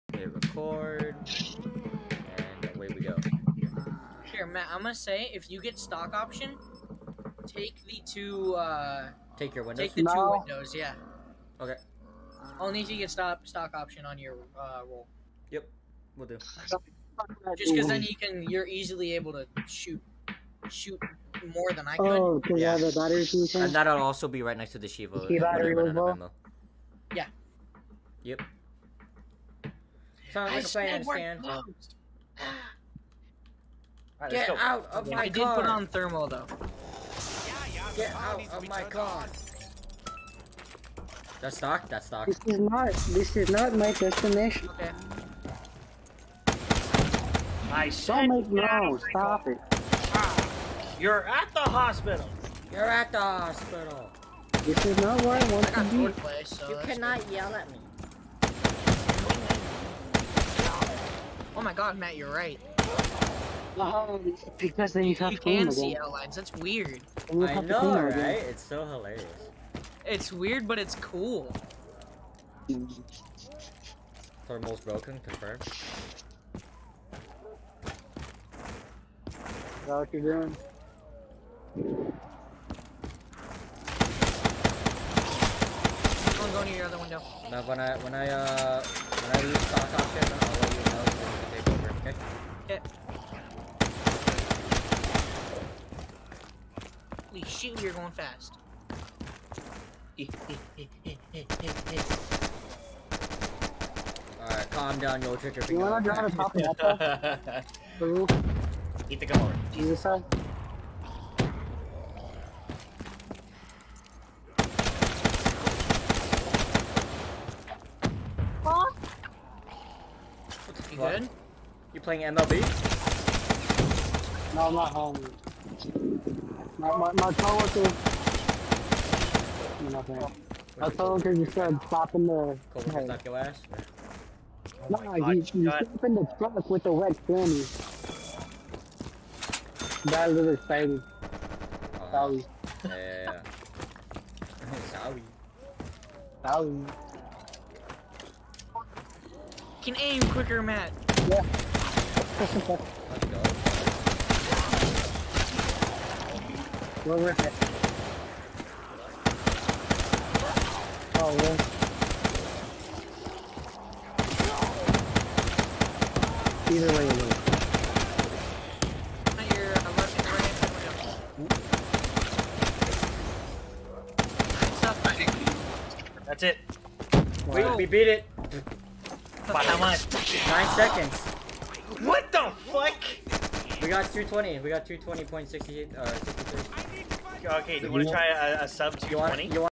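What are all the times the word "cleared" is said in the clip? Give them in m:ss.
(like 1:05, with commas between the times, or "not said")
not said.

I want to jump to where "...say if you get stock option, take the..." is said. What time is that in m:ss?
0:04.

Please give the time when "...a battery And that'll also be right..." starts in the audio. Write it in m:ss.
0:22.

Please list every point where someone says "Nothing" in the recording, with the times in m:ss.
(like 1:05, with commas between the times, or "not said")
2:09.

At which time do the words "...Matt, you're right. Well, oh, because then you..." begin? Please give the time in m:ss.
1:01.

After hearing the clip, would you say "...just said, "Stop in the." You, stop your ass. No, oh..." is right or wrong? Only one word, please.
wrong.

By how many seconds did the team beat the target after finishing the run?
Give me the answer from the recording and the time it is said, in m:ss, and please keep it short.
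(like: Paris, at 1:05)
9, at 3:00.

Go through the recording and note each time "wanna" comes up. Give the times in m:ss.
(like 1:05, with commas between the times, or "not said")
1:45.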